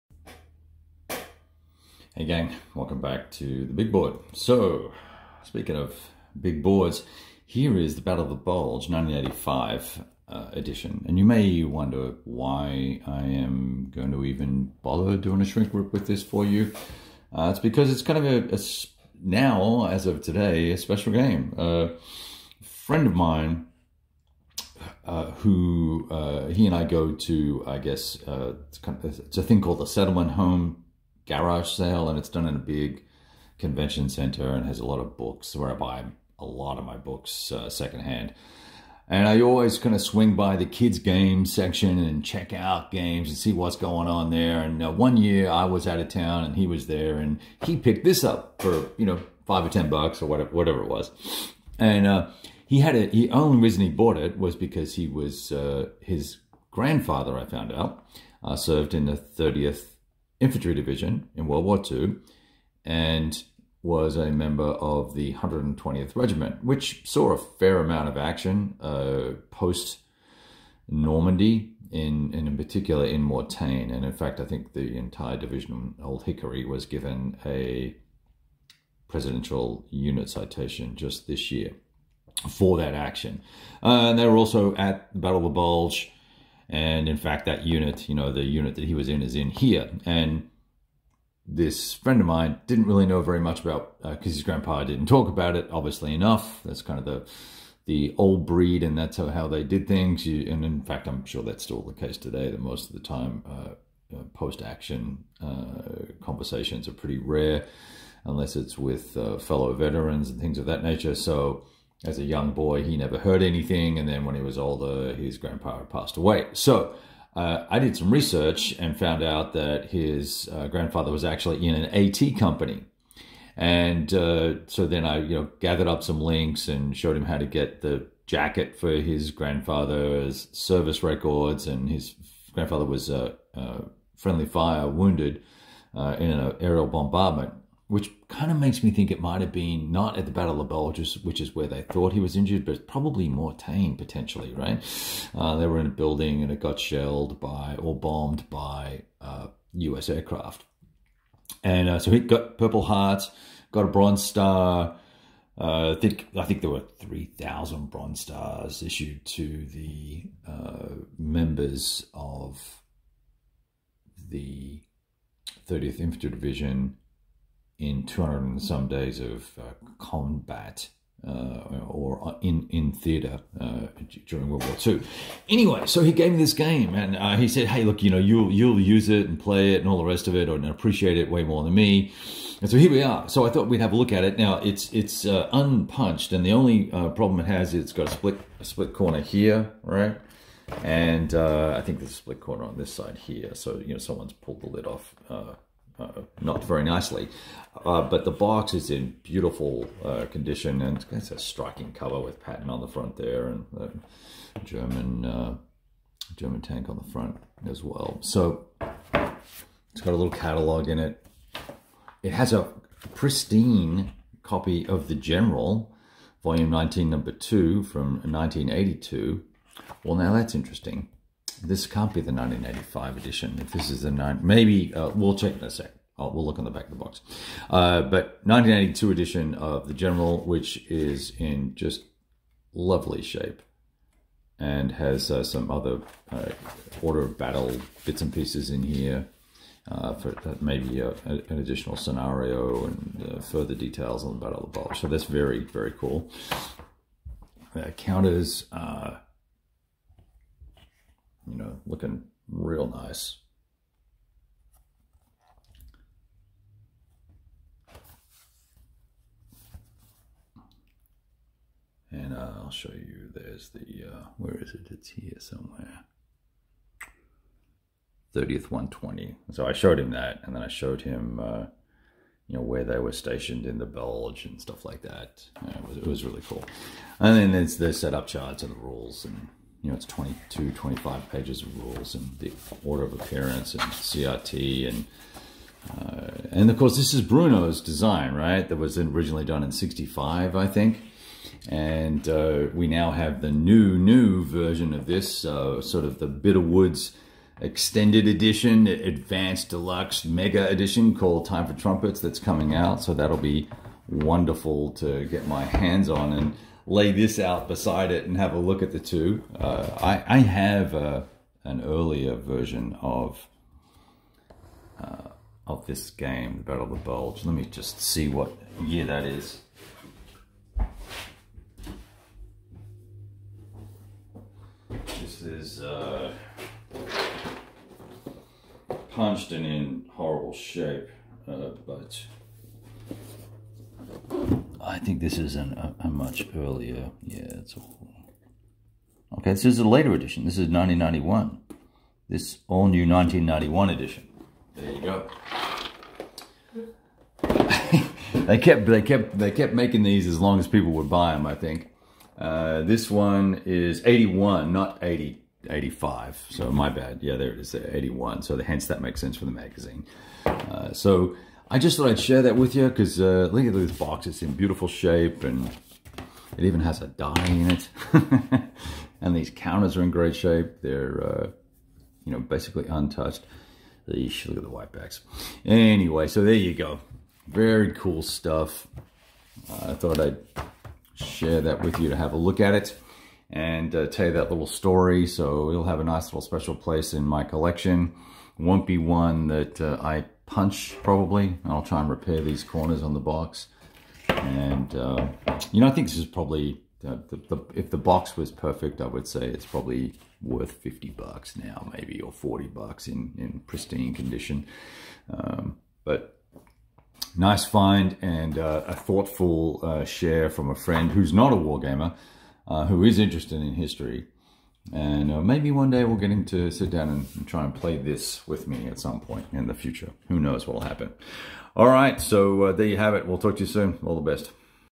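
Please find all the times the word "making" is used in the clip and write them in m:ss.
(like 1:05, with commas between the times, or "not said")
5:49.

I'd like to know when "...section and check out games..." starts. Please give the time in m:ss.
0:41.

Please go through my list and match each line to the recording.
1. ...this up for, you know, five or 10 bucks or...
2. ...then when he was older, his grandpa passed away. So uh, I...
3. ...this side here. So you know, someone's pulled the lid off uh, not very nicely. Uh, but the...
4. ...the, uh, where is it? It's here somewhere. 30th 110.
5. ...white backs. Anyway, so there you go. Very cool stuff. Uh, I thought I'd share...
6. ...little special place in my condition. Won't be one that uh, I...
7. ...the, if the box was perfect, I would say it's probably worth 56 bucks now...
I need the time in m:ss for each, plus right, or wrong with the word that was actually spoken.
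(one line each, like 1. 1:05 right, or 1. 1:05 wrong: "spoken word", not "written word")
1. 0:48 right
2. 1:54 right
3. 3:12 right
4. 4:23 wrong: "120", not "110"
5. 6:14 right
6. 6:26 wrong: "collection", not "condition"
7. 6:37 wrong: "50", not "56".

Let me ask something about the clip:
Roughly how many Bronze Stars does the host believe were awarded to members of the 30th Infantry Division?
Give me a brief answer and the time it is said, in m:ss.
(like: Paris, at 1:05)
3,000, at 2:36.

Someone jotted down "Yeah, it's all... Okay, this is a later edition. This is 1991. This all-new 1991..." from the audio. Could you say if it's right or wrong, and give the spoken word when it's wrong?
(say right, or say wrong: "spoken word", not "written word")
right.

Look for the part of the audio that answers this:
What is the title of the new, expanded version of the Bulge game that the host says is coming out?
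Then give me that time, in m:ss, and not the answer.
5:01.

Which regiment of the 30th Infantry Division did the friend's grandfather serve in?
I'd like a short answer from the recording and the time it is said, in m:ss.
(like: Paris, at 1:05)
120th Regiment, at 1:05.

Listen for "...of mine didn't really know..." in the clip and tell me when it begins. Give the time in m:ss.
1:32.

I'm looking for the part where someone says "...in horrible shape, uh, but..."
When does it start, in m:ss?
5:29.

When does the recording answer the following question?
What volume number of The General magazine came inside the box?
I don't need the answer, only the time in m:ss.
3:36.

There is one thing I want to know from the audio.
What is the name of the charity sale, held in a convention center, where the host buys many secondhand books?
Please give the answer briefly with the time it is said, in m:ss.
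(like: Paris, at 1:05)
Settlement Home garage sale, at 0:29.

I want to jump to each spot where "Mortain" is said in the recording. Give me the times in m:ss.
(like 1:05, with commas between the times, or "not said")
1:13, 2:23.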